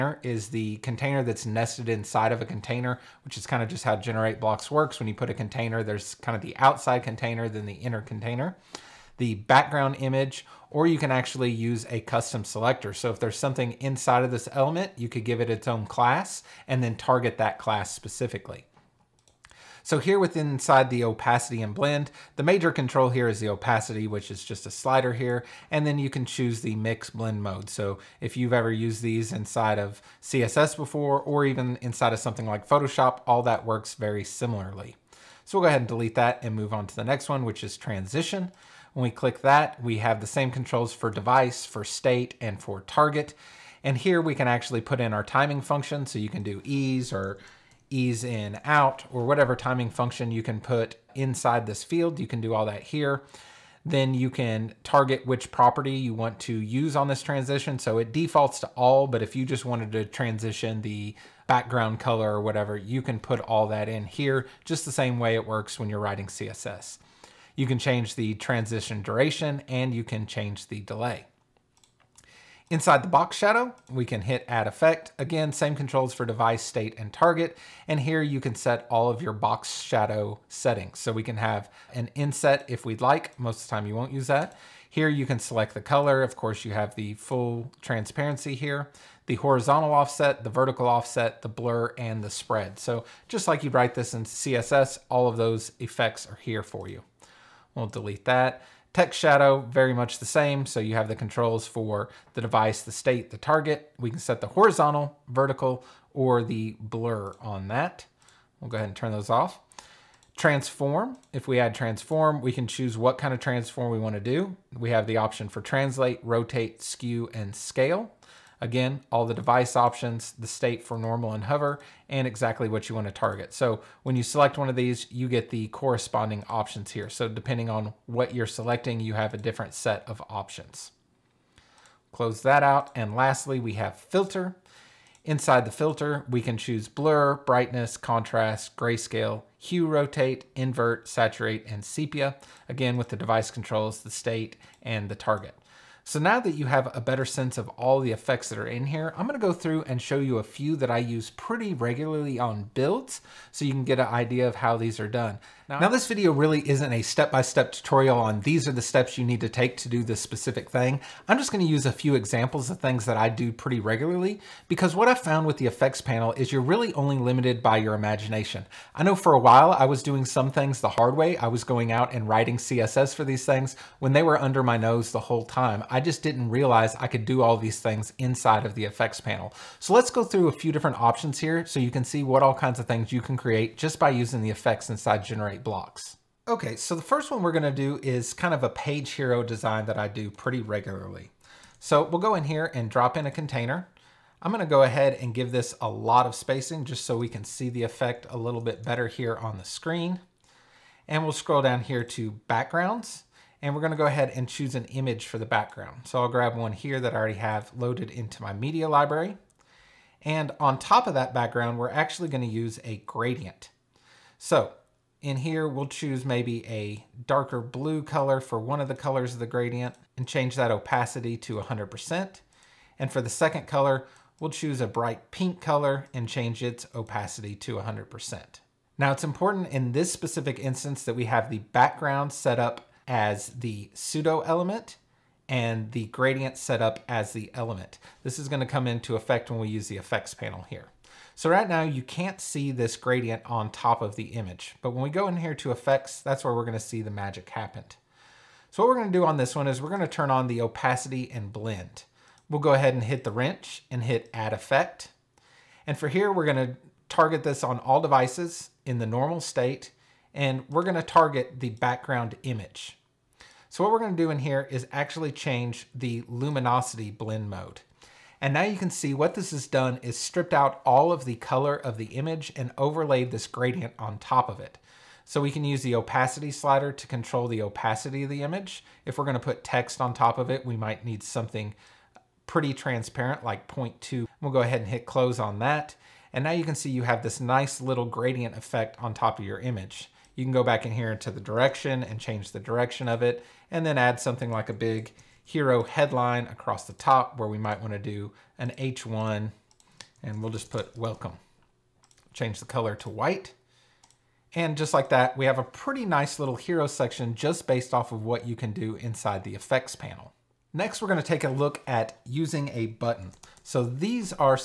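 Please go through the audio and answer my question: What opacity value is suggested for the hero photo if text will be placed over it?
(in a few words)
0.2.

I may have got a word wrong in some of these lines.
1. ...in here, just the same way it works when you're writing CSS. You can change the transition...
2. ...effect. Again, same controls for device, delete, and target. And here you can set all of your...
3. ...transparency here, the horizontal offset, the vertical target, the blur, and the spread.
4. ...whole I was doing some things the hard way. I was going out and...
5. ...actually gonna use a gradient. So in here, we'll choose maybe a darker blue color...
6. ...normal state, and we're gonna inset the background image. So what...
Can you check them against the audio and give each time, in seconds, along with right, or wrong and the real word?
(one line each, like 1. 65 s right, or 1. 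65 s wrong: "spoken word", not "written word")
1. 63 s right
2. 74 s wrong: "state", not "delete"
3. 87 s wrong: "offset", not "target"
4. 169 s wrong: "while", not "whole"
5. 211 s right
6. 259 s wrong: "target", not "inset".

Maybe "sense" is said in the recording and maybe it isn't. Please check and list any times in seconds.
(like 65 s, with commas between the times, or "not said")
147 s.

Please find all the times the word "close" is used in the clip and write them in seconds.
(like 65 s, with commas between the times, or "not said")
132 s, 285 s.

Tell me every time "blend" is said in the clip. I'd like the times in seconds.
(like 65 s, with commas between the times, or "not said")
21 s, 27 s, 251 s, 267 s.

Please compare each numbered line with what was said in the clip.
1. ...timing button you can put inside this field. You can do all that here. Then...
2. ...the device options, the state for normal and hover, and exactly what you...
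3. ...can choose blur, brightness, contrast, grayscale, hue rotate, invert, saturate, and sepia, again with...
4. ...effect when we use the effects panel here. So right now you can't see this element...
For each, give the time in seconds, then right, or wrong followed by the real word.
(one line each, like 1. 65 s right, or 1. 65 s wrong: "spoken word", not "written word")
1. 49 s wrong: "function", not "button"
2. 119 s right
3. 136 s right
4. 239 s wrong: "gradient", not "element".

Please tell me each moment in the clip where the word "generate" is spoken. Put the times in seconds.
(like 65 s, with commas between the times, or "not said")
3 s, 185 s.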